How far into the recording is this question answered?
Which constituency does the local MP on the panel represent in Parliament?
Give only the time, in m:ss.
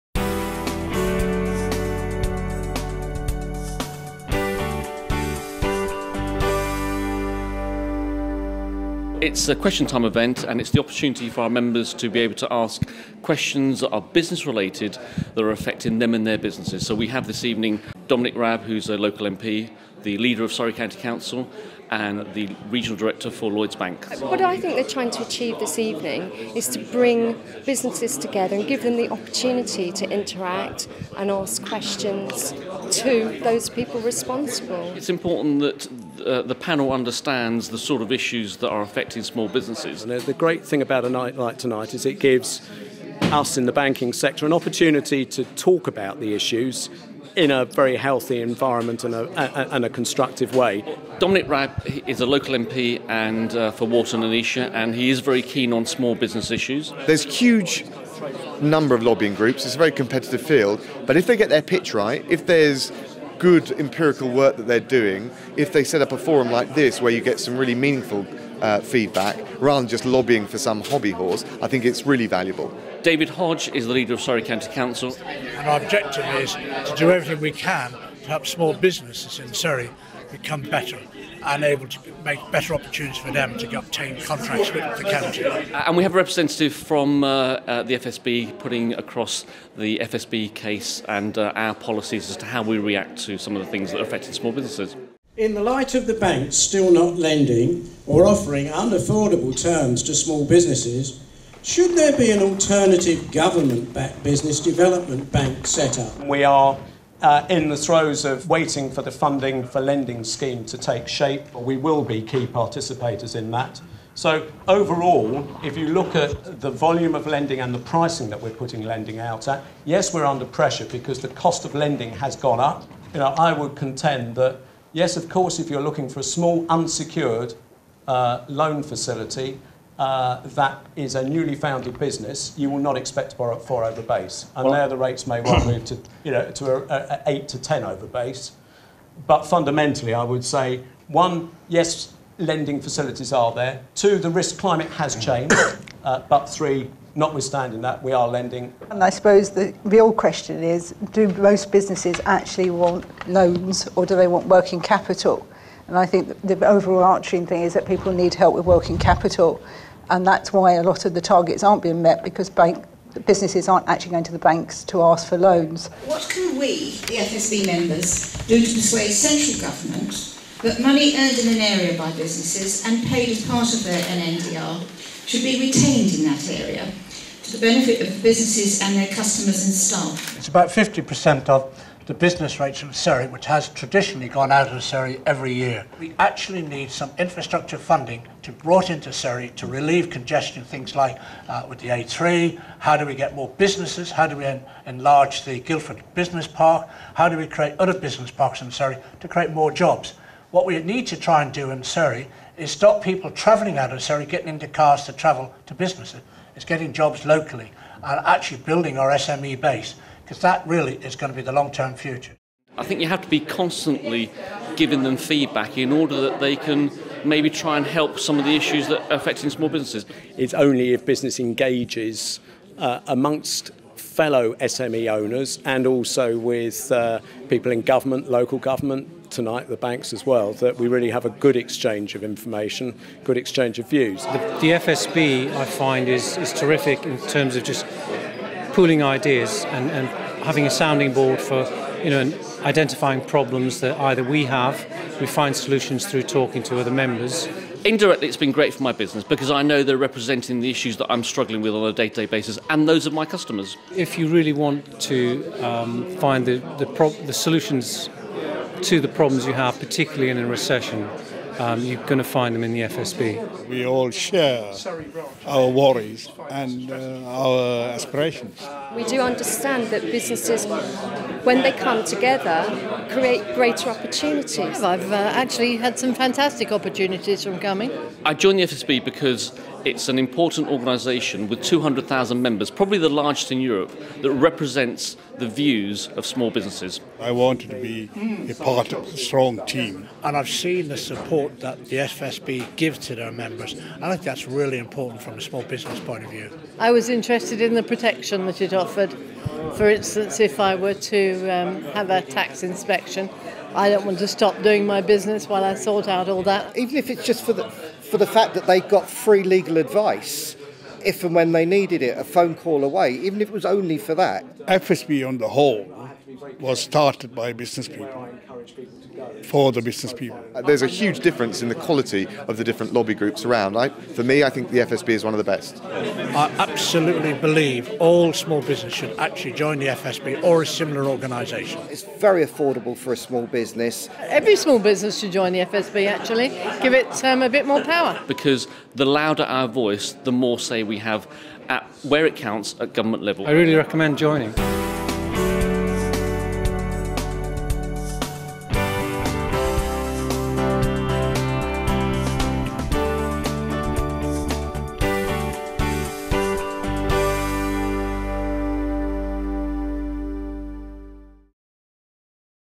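0:53.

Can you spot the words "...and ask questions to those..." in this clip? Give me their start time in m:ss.
0:31.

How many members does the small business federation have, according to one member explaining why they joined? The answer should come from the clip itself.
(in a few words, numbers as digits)
200,000.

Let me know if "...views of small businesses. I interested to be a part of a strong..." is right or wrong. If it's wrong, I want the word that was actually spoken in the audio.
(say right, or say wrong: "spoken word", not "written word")
wrong: "wanted", not "interested".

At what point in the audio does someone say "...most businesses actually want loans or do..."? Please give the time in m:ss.
2:31.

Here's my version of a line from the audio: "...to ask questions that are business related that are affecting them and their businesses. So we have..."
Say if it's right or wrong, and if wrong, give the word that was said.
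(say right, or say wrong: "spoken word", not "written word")
right.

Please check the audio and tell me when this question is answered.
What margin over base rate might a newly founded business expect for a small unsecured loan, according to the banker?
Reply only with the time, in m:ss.
2:17.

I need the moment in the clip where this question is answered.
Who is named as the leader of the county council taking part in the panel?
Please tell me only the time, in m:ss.
1:13.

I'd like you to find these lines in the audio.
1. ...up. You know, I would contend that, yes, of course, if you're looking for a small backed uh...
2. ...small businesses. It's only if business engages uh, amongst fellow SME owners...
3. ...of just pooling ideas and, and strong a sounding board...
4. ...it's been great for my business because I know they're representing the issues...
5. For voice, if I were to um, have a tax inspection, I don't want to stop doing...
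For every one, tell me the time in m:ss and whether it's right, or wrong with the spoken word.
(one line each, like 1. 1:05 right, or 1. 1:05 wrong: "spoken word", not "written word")
1. 2:02 wrong: "unsecured", not "backed"
2. 3:39 right
3. 3:57 wrong: "having", not "strong"
4. 4:08 right
5. 4:59 wrong: "instance", not "voice".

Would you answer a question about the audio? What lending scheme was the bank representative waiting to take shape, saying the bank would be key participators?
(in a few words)
Funding for lending scheme.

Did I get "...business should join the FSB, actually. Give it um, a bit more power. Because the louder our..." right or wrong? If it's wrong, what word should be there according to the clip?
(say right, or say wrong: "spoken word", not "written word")
right.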